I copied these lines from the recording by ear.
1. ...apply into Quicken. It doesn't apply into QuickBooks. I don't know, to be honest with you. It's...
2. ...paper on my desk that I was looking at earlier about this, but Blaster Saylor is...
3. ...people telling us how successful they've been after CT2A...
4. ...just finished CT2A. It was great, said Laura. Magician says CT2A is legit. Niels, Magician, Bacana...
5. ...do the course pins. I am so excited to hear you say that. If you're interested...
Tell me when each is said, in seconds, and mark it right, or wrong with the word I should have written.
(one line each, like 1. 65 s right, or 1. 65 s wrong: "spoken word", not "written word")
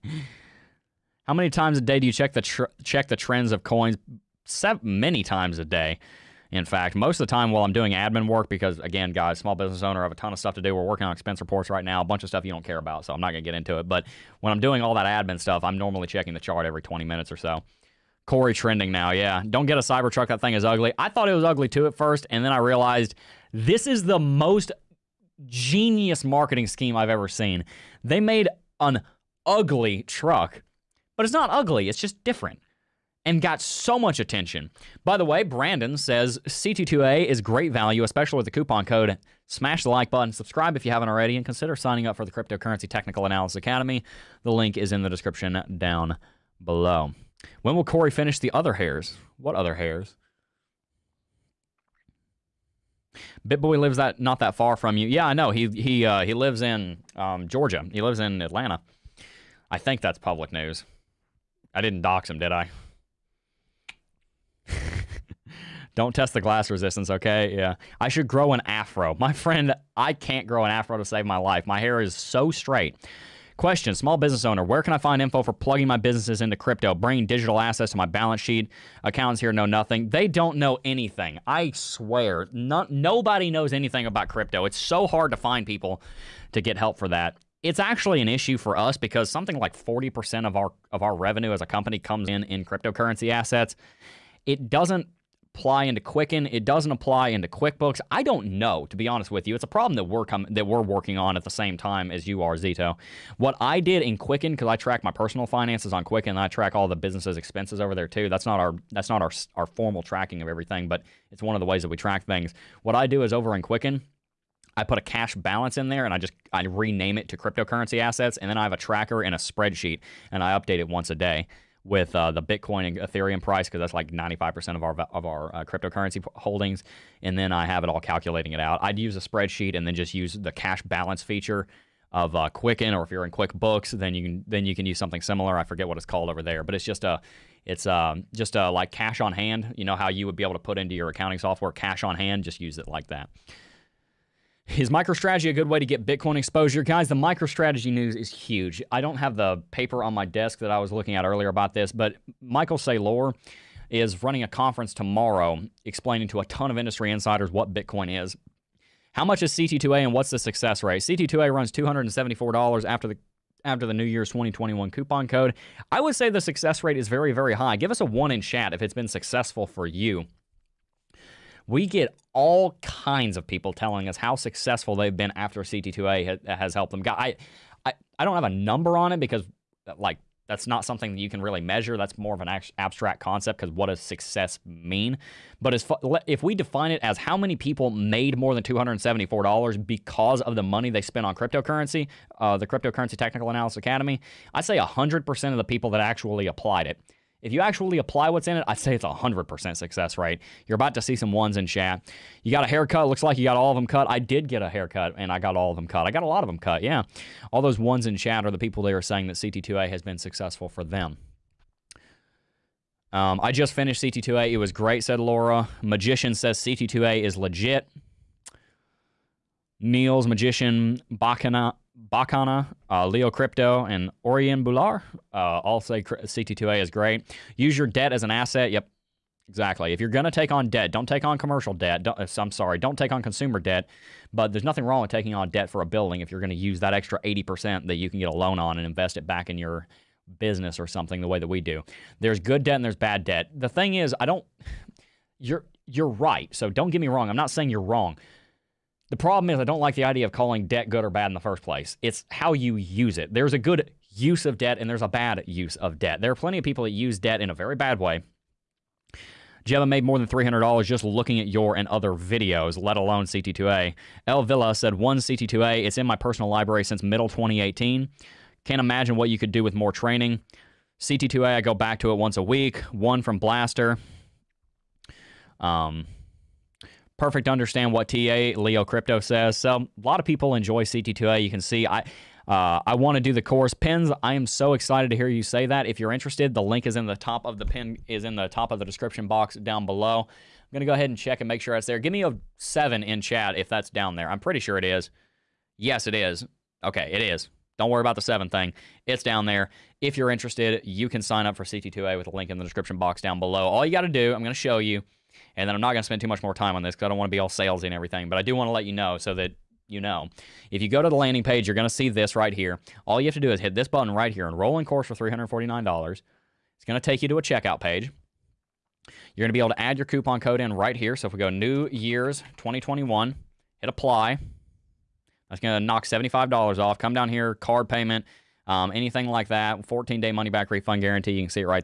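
1. 95 s right
2. 149 s wrong: "Michael", not "Blaster"
3. 173 s right
4. 213 s right
5. 283 s right.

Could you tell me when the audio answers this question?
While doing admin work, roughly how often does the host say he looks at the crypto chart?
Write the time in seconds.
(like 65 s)
16 s.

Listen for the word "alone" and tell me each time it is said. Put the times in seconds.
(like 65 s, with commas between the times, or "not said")
262 s.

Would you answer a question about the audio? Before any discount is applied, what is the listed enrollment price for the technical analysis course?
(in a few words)
$349.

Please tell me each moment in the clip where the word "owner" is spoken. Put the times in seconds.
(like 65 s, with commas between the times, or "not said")
9 s, 74 s.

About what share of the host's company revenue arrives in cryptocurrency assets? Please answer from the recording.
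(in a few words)
40%.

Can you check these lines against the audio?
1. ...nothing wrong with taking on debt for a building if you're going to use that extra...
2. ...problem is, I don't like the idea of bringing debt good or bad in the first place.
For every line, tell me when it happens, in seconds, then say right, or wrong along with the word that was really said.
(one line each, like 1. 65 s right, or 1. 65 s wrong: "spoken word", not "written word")
1. 234 s right
2. 249 s wrong: "calling", not "bringing".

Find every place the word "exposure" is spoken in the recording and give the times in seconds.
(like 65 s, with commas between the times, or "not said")
146 s.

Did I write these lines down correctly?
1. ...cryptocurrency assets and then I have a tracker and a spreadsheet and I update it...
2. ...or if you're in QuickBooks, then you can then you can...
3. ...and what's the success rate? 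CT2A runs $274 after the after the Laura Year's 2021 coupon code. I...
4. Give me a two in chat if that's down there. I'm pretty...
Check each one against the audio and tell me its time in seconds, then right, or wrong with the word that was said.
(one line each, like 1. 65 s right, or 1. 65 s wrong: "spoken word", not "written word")
1. 117 s right
2. 132 s right
3. 159 s wrong: "New", not "Laura"
4. 291 s wrong: "seven", not "two".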